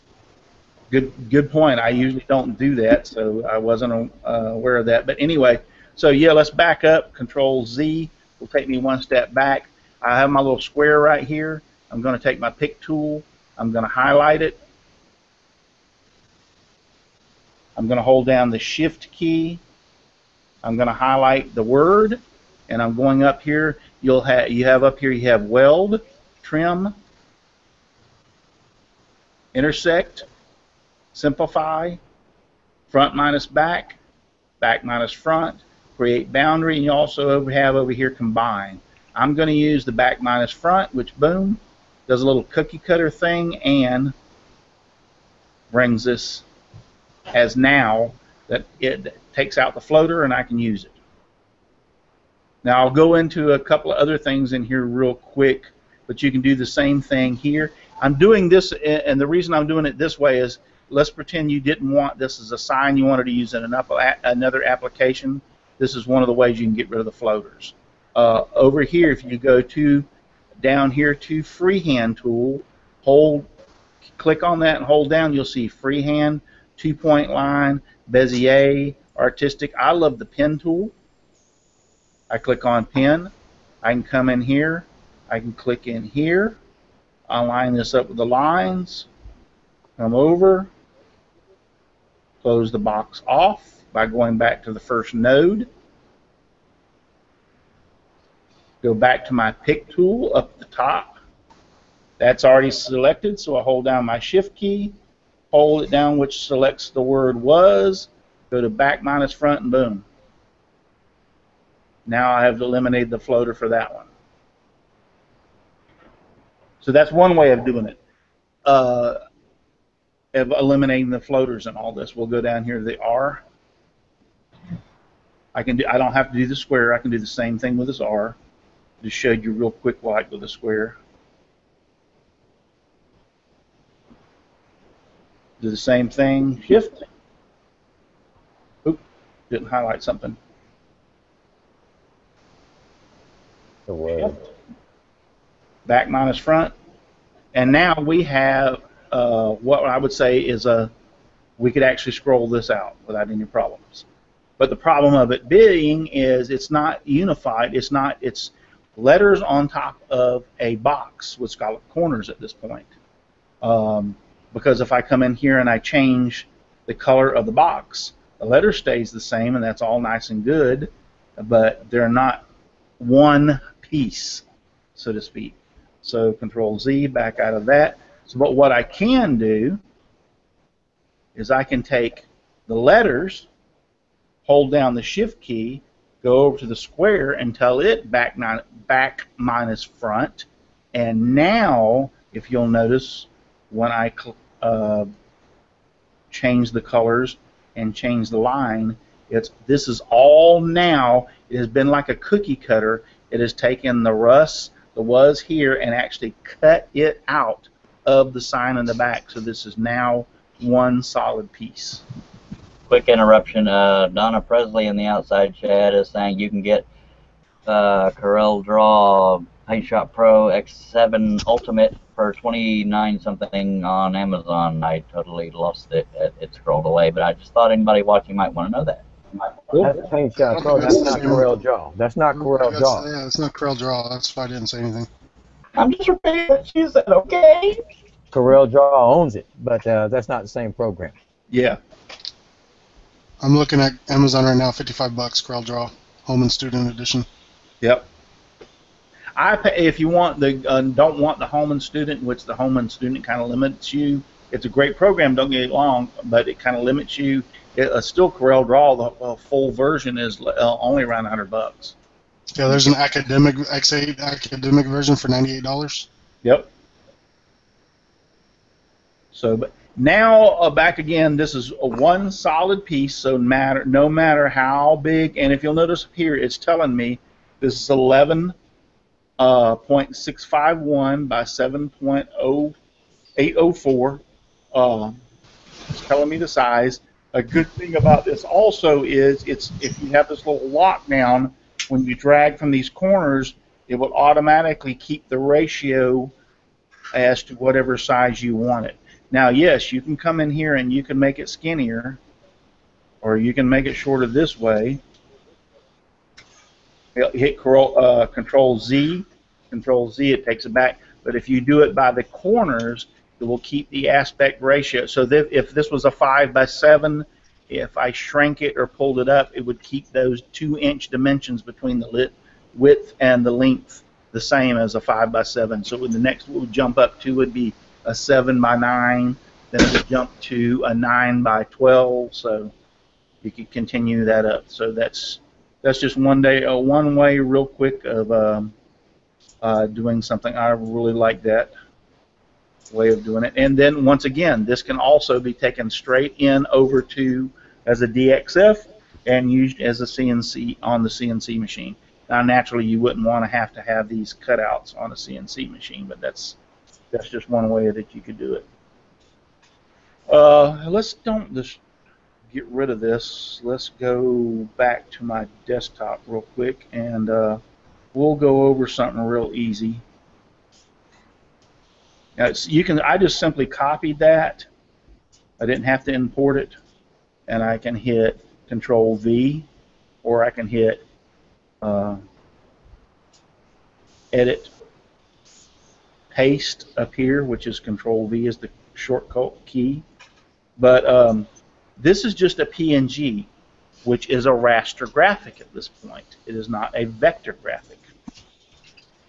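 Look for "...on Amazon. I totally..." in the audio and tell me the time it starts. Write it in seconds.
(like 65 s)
223 s.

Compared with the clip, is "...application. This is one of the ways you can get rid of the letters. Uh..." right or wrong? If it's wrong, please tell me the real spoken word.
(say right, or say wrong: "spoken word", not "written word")
wrong: "floaters", not "letters".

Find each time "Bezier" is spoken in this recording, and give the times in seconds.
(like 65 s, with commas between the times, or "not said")
78 s.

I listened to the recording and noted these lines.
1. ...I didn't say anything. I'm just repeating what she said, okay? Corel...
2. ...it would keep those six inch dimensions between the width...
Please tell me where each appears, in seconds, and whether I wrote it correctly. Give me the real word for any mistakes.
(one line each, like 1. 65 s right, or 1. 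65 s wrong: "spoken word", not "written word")
1. 234 s right
2. 319 s wrong: "two", not "six".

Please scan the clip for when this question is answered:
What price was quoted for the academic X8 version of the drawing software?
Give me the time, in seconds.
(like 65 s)
265 s.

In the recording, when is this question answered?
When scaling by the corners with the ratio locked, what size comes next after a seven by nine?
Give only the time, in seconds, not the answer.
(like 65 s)
330 s.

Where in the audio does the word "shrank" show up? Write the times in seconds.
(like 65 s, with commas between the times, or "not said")
318 s.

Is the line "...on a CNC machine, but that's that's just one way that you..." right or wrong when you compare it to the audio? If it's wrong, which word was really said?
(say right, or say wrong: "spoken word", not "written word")
right.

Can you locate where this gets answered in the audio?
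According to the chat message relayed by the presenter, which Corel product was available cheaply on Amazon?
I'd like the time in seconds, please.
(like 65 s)
219 s.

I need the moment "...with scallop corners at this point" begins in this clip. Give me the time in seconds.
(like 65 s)
161 s.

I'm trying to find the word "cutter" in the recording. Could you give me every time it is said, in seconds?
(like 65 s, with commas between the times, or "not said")
42 s, 202 s.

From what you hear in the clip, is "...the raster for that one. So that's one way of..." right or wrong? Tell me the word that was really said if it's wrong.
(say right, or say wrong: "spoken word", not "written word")
wrong: "floater", not "raster".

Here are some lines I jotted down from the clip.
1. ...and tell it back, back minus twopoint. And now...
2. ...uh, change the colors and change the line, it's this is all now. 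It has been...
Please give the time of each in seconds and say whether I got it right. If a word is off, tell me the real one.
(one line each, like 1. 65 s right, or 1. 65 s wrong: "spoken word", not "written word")
1. 187 s wrong: "front", not "twopoint"
2. 194 s right.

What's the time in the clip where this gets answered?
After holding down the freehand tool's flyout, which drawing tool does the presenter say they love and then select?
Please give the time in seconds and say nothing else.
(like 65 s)
80 s.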